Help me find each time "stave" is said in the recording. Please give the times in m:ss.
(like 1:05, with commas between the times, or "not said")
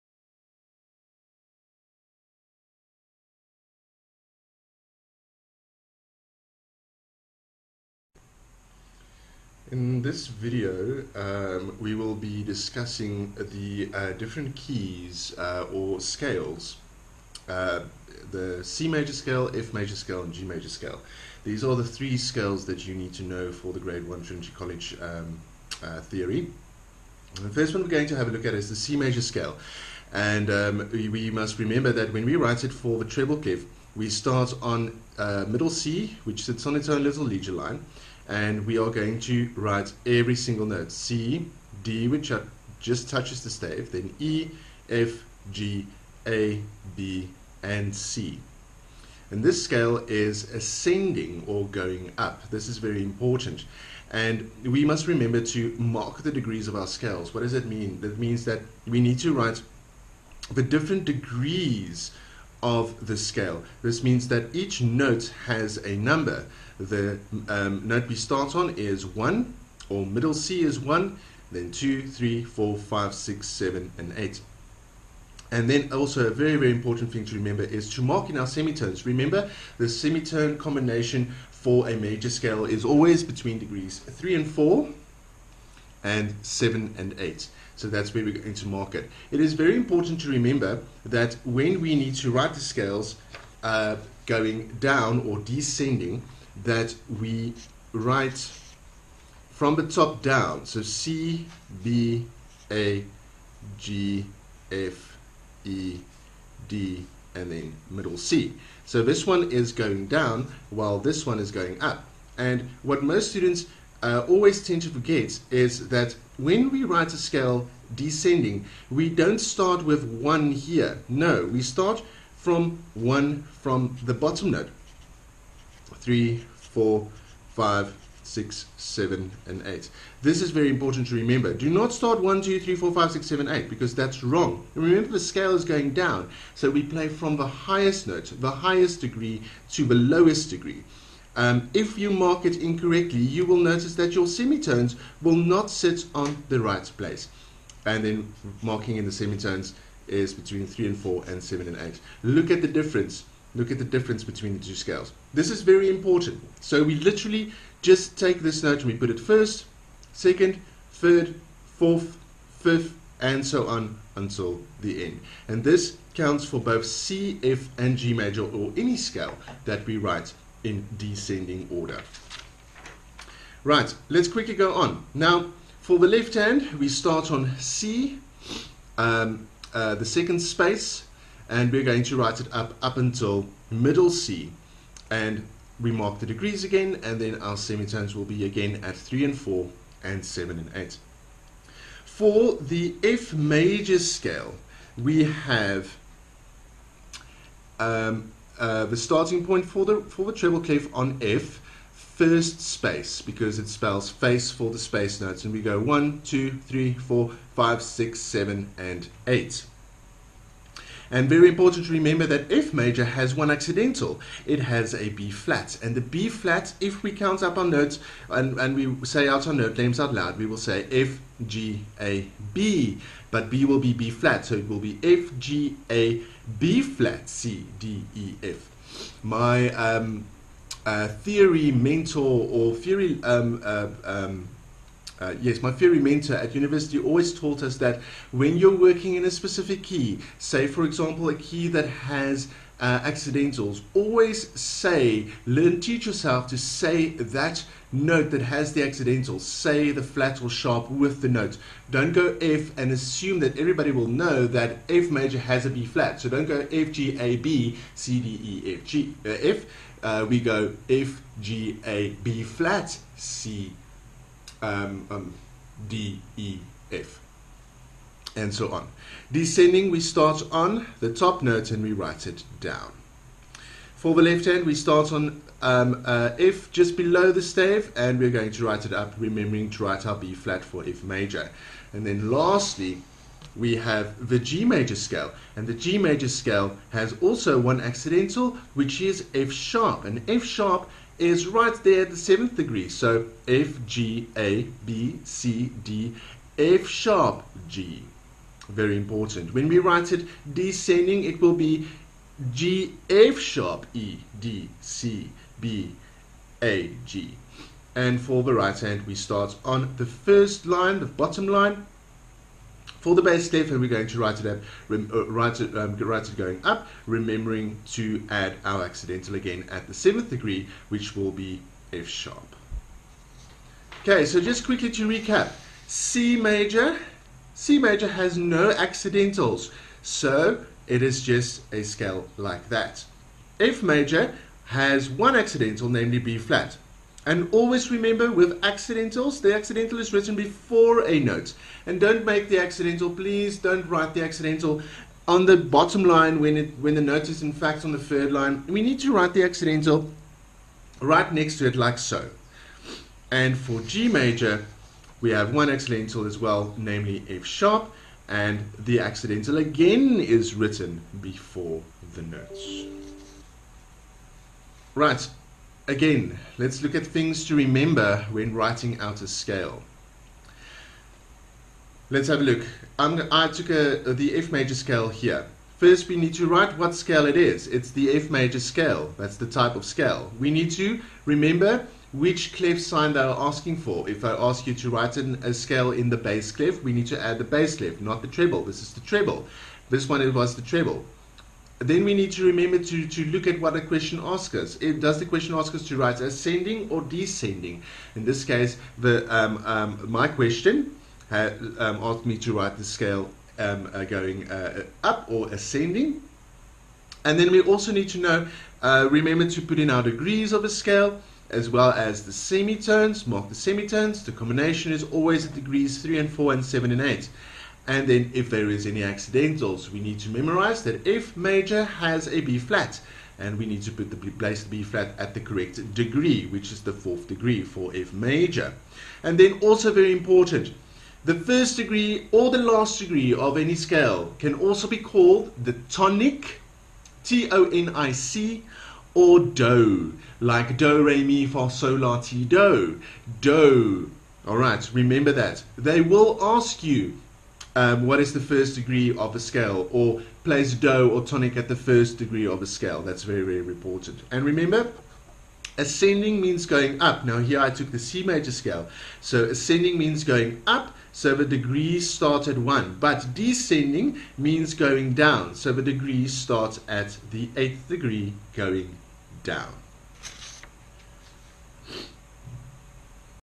0:43, 4:37, 5:13.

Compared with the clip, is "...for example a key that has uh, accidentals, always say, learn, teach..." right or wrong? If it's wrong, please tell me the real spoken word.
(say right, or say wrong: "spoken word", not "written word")
right.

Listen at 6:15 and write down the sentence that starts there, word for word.
First, we need to write what scale it is.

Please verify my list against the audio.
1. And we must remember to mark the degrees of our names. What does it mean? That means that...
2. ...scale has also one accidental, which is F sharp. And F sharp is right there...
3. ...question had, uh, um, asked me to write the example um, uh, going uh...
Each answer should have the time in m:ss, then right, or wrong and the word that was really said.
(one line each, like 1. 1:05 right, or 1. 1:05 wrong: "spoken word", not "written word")
1. 0:54 wrong: "scales", not "names"
2. 4:46 right
3. 6:40 wrong: "scale", not "example".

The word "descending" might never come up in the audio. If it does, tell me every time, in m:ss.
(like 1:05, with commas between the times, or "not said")
1:35, 1:57, 2:50, 4:29, 5:00, 6:37, 7:43.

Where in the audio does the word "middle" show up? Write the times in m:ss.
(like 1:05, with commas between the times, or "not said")
0:35, 1:10, 1:47, 3:03.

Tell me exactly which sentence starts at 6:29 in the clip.
This one it was the treble then we need to remember to, to look at what the question asks us.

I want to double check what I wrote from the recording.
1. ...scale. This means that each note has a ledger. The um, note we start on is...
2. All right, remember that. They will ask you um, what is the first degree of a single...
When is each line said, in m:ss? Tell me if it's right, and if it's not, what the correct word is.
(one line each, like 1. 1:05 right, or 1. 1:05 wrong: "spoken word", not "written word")
1. 1:03 wrong: "number", not "ledger"
2. 7:24 wrong: "scale", not "single".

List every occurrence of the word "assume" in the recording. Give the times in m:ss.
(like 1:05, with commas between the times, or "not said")
4:12.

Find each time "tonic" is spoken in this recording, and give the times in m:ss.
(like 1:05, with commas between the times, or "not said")
7:15, 7:31.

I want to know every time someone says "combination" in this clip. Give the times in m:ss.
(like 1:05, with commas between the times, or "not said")
1:20, 6:54.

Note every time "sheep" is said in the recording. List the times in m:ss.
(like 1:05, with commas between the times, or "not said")
not said.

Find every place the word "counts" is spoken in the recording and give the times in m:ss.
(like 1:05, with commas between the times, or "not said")
2:46, 3:37.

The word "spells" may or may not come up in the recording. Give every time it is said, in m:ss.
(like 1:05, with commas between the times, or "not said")
3:23.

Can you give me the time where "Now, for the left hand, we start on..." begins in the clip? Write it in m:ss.
2:55.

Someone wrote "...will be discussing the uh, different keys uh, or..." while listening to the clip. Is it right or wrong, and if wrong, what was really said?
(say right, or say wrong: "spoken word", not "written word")
right.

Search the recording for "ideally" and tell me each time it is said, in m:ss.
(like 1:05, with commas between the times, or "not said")
not said.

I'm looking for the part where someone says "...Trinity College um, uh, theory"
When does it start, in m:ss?
0:24.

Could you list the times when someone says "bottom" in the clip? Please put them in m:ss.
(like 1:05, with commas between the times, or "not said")
2:04, 5:11, 5:45.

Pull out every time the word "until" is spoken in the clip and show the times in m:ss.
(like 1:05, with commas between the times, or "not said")
2:44, 3:02.